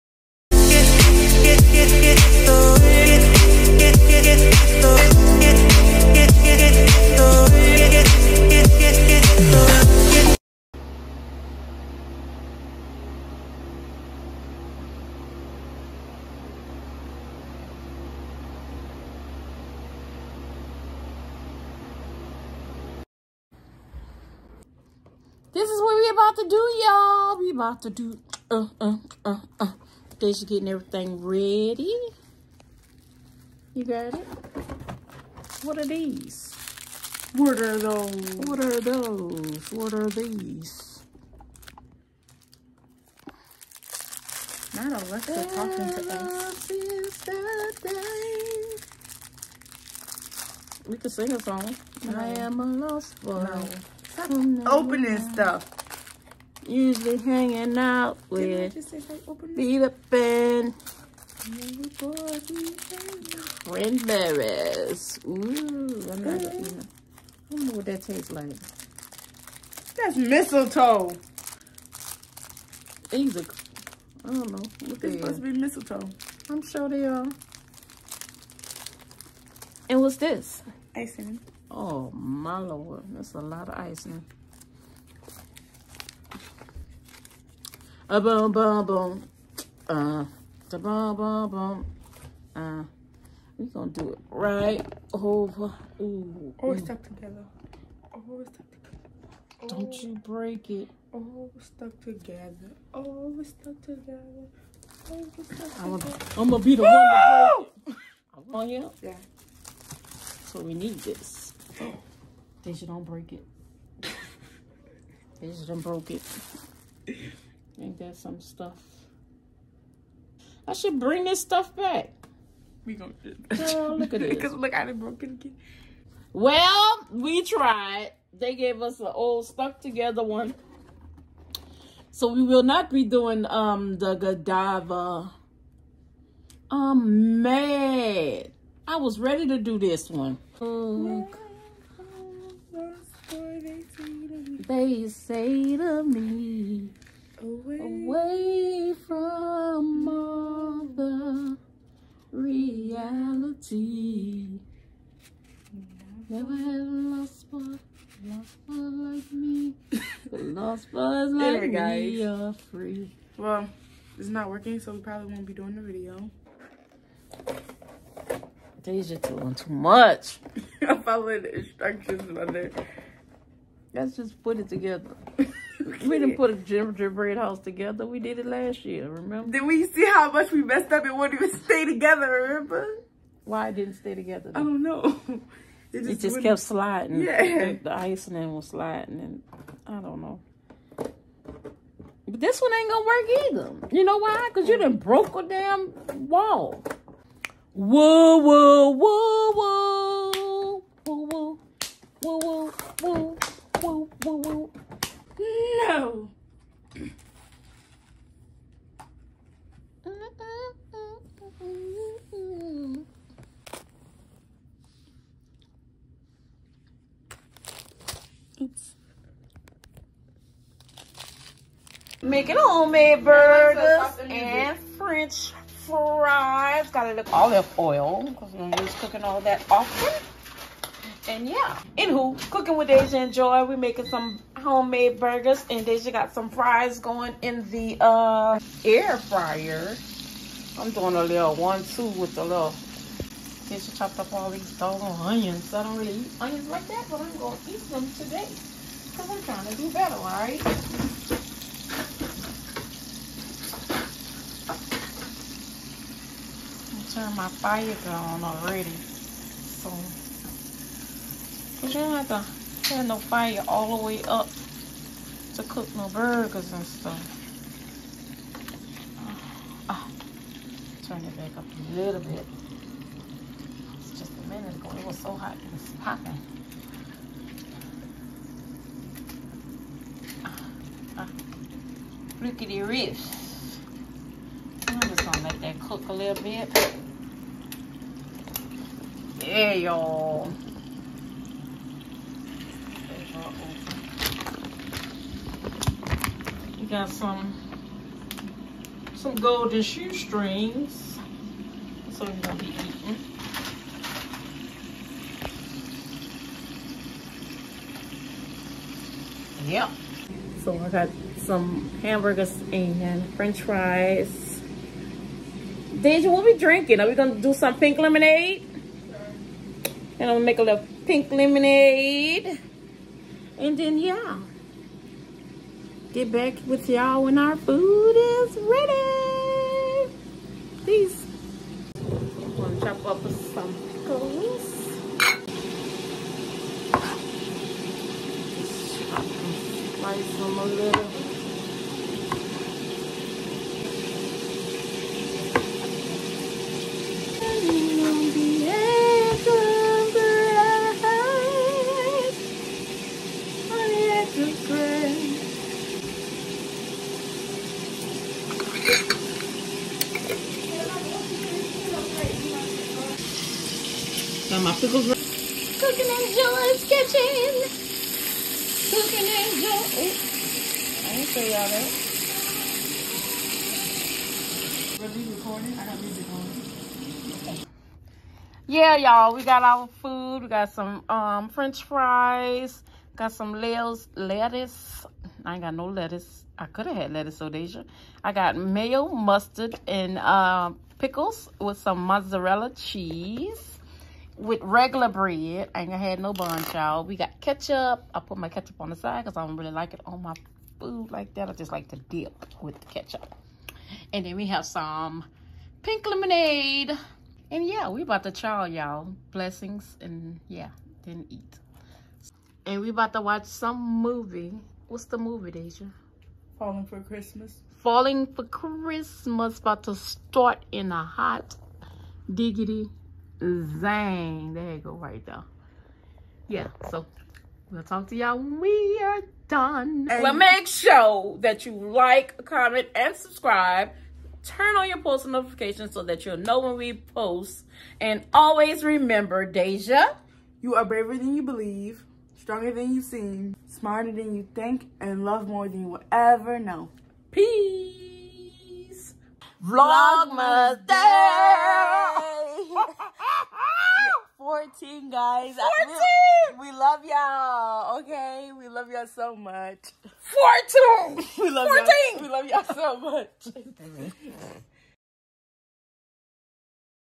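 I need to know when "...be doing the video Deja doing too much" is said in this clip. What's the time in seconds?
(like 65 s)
165 s.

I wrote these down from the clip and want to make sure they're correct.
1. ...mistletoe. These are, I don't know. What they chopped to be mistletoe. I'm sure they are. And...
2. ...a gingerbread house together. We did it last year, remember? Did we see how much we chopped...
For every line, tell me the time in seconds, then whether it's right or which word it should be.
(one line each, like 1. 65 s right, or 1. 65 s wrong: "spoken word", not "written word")
1. 70 s wrong: "supposed", not "chopped"
2. 176 s wrong: "messed", not "chopped".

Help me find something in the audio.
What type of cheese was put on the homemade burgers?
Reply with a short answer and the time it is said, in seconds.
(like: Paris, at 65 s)
mozzarella, at 391 s.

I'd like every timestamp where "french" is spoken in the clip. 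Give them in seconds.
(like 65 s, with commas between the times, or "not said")
224 s, 313 s, 381 s.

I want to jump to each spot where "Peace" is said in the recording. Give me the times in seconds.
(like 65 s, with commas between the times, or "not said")
330 s, 447 s.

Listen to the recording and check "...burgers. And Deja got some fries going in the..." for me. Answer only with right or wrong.
right.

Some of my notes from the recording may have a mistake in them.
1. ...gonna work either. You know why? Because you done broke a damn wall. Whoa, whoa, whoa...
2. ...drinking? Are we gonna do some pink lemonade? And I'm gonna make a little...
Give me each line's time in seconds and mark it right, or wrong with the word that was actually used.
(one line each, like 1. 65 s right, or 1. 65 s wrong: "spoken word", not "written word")
1. 192 s right
2. 316 s right.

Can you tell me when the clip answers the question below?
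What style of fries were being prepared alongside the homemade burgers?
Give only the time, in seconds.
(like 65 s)
299 s.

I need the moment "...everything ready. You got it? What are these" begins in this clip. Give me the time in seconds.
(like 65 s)
30 s.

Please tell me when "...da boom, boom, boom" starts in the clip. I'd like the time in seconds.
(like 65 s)
90 s.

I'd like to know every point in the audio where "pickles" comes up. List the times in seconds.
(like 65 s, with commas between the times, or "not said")
333 s, 390 s.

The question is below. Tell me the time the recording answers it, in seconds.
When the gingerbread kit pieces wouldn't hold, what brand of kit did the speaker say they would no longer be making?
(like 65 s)
134 s.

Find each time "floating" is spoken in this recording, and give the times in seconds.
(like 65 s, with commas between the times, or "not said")
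not said.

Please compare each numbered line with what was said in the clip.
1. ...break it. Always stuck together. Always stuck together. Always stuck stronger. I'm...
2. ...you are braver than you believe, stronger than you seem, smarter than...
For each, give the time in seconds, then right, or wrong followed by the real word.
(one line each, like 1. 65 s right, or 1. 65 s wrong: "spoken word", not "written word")
1. 100 s wrong: "together", not "stronger"
2. 440 s right.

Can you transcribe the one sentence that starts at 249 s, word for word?
Because I'm trying to do better, all right?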